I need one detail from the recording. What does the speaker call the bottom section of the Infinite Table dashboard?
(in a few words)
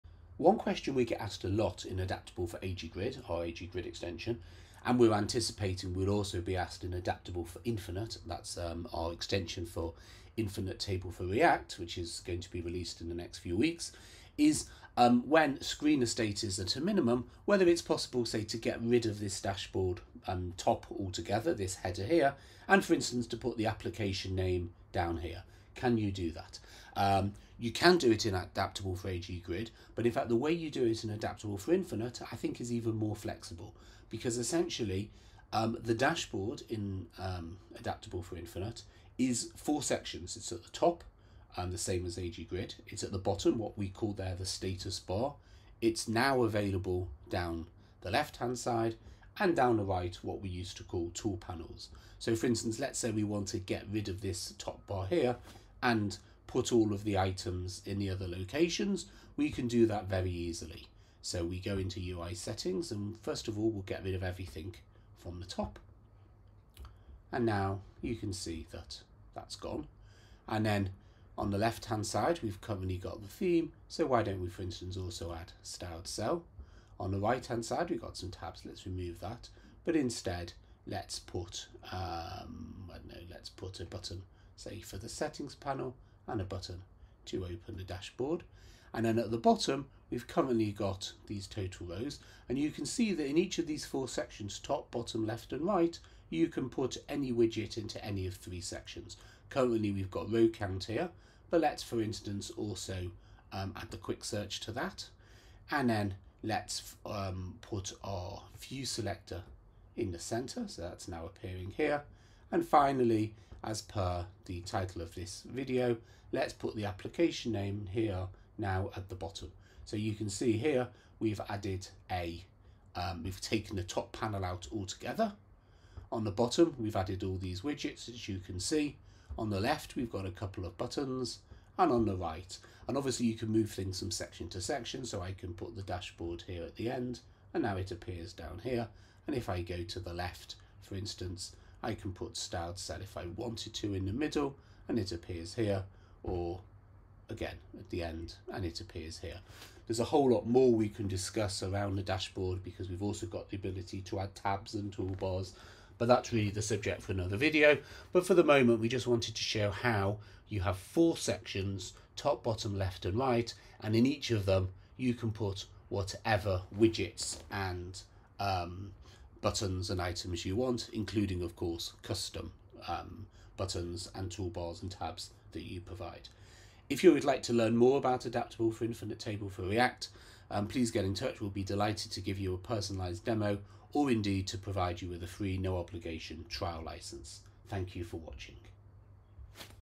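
Status bar.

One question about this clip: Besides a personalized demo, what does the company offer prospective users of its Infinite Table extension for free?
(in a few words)
Trial license.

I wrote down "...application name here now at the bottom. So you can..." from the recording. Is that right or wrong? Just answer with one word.
right.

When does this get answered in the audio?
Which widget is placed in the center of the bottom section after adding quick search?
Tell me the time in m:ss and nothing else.
1:48.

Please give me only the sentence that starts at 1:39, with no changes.
Currently we've got row count here, but let's for instance also um, add the quick search to that.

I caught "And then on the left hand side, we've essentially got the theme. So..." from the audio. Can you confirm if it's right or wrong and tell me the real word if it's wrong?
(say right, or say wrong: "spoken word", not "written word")
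wrong: "currently", not "essentially".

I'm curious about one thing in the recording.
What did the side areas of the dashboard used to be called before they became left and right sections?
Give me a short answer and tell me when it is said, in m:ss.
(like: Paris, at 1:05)
Tool panels, at 0:51.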